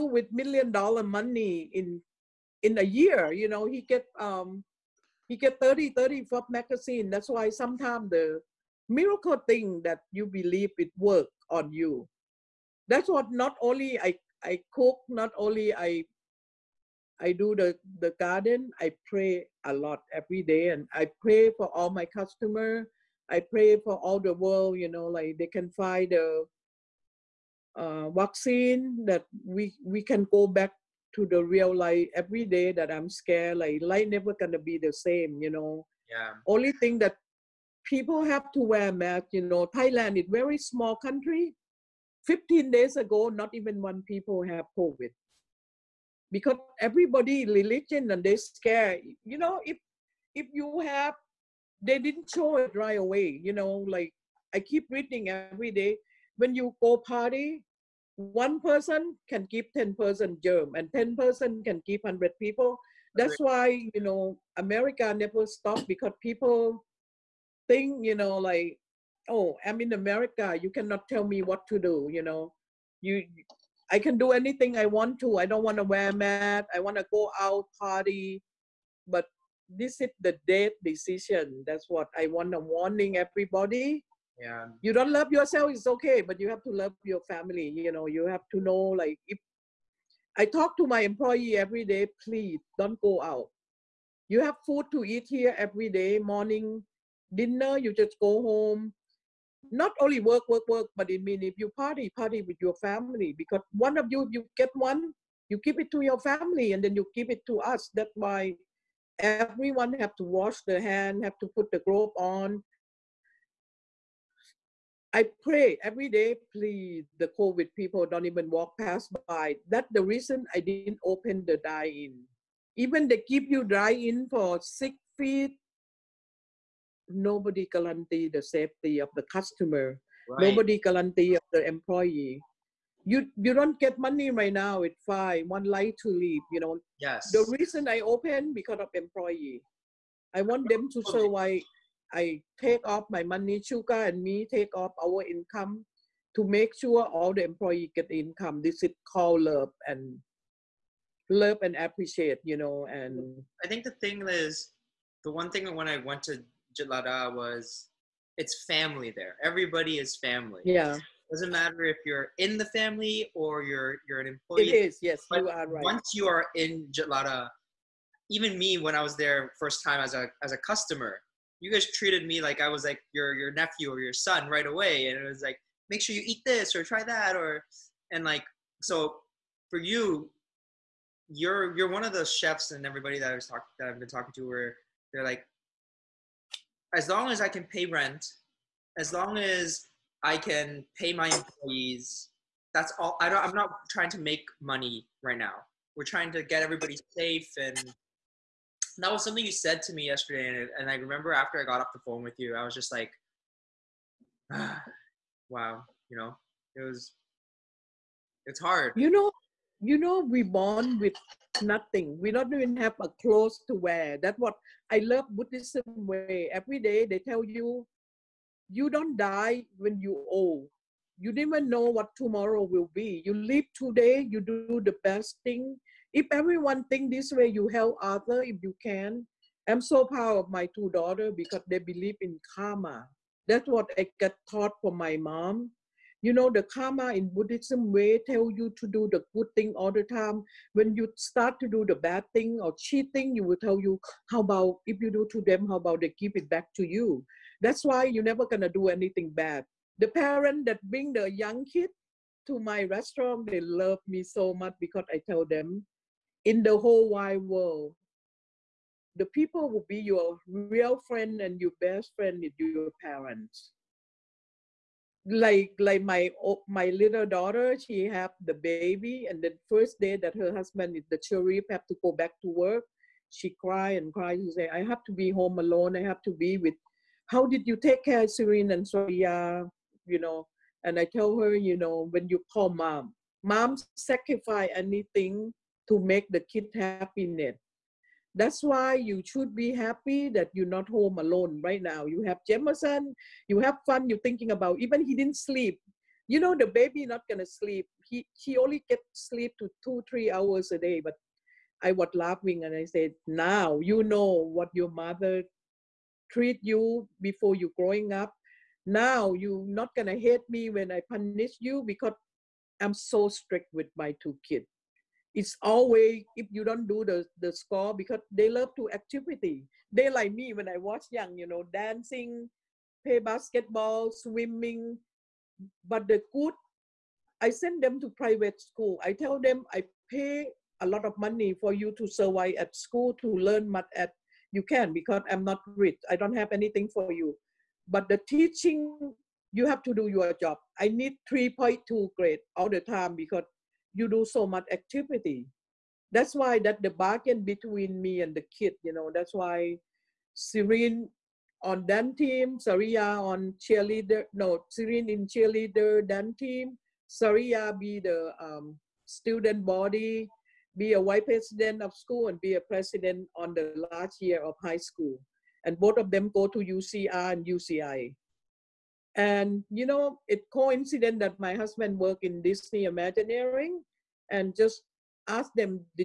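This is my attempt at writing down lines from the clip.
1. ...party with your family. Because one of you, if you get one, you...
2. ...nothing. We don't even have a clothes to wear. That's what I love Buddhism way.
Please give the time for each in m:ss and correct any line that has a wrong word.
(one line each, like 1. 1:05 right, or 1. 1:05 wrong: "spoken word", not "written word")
1. 1:42 right
2. 3:31 right.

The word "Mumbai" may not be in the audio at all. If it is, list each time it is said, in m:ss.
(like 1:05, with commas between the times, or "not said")
not said.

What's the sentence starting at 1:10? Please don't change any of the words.
You cannot tell me what to do, you know.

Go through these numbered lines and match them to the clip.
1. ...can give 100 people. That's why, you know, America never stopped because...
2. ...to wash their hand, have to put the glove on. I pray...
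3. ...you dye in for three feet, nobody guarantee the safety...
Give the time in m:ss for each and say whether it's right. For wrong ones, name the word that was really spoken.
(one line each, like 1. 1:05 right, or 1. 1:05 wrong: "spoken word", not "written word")
1. 1:01 right
2. 1:50 right
3. 2:03 wrong: "six", not "three".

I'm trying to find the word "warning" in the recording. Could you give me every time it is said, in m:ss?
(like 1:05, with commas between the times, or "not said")
1:22.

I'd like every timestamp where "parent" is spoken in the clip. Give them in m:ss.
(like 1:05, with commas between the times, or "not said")
4:10, 4:23.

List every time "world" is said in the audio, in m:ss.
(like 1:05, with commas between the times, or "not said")
0:24, 4:17.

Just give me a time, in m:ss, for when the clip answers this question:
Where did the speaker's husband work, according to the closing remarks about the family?
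6:12.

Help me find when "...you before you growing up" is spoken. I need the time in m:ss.
5:06.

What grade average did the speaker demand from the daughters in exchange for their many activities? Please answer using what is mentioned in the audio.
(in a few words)
3.2.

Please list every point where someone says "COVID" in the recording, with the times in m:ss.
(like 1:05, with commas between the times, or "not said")
0:44, 1:57.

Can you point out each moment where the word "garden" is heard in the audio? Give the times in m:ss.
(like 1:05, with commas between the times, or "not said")
0:18.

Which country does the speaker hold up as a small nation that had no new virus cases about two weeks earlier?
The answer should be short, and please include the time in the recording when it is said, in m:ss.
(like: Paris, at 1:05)
Thailand, at 0:39.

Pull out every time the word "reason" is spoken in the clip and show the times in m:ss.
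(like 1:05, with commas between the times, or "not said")
2:00, 2:17.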